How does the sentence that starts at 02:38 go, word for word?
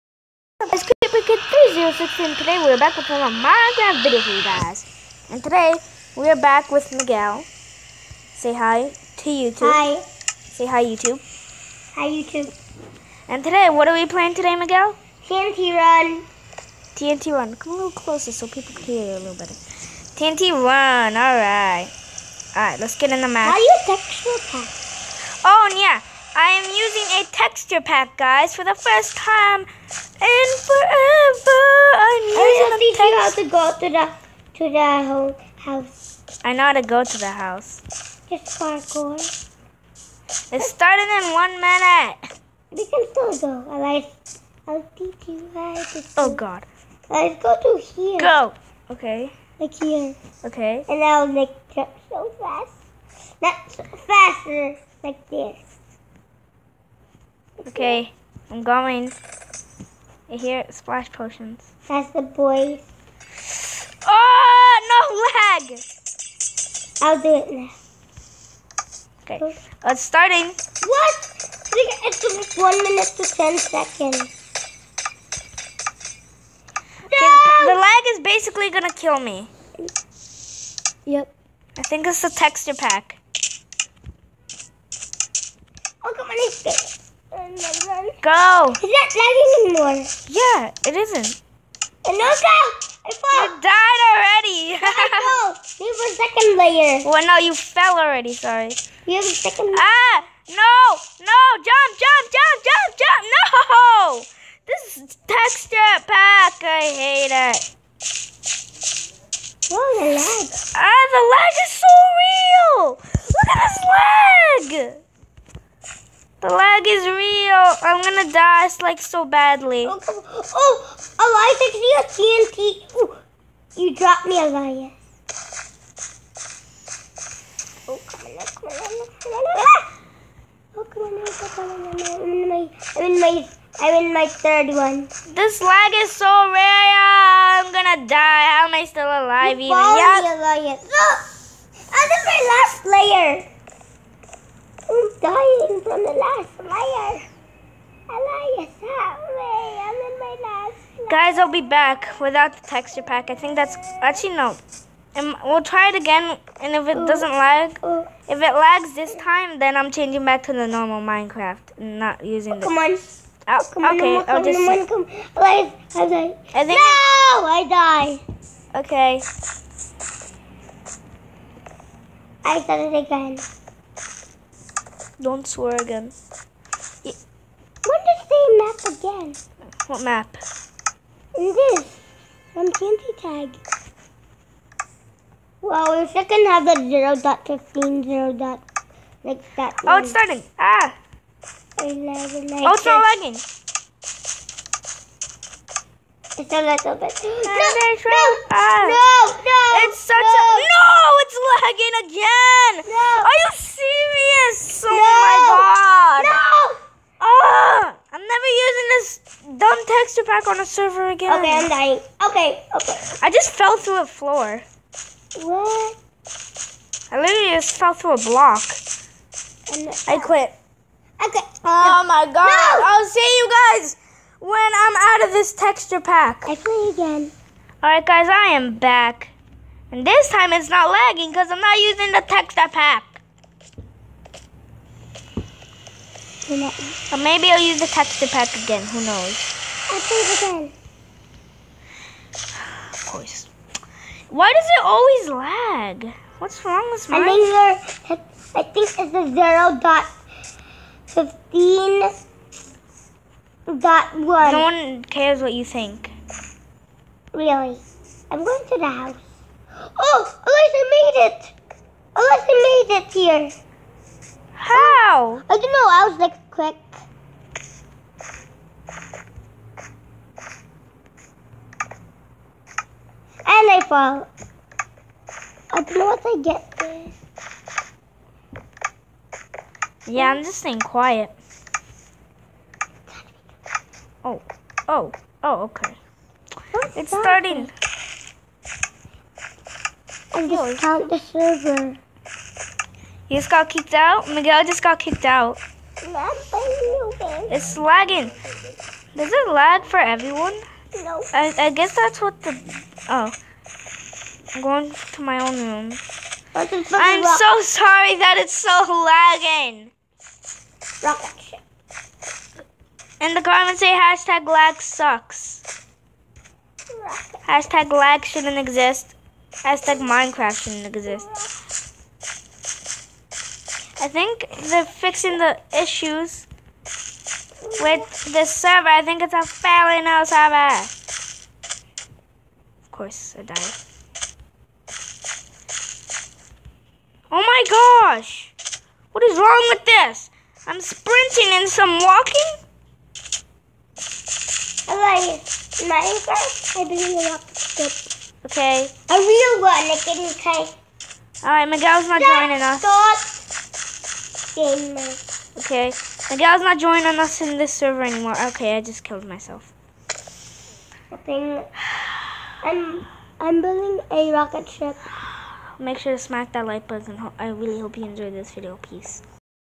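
if it lags this time, then I'm changing back to the normal Minecraft, not using.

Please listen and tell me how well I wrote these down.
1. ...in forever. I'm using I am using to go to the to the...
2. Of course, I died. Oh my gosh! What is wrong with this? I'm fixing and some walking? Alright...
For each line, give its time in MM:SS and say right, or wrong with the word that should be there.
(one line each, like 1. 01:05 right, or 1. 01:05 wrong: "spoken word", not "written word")
1. 00:29 right
2. 05:32 wrong: "sprinting", not "fixing".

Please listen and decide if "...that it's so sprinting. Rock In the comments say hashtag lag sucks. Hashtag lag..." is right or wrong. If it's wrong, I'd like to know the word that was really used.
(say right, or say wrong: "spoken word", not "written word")
wrong: "lagging", not "sprinting".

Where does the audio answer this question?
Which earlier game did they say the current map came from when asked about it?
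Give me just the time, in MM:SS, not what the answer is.
03:02.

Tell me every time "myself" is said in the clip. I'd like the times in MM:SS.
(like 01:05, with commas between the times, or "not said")
05:59.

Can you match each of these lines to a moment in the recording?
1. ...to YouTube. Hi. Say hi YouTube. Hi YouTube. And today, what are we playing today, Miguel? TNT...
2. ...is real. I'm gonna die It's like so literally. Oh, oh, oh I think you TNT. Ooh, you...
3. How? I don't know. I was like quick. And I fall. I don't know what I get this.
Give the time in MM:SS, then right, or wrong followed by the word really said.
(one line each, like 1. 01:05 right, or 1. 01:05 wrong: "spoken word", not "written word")
1. 00:08 right
2. 01:56 wrong: "badly", not "literally"
3. 04:24 right.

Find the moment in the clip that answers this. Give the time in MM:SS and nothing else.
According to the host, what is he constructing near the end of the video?
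06:04.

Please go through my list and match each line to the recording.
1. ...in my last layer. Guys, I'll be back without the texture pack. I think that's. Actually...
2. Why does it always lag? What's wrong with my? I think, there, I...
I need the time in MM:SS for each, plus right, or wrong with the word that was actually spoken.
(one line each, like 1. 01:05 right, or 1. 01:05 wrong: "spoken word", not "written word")
1. 02:30 right
2. 04:04 right.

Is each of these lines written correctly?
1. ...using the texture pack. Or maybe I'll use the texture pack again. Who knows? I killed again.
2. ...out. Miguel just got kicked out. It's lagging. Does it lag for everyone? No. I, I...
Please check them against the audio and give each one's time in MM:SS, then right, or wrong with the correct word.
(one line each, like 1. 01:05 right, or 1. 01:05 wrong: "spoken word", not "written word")
1. 03:51 wrong: "played", not "killed"
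2. 04:53 right.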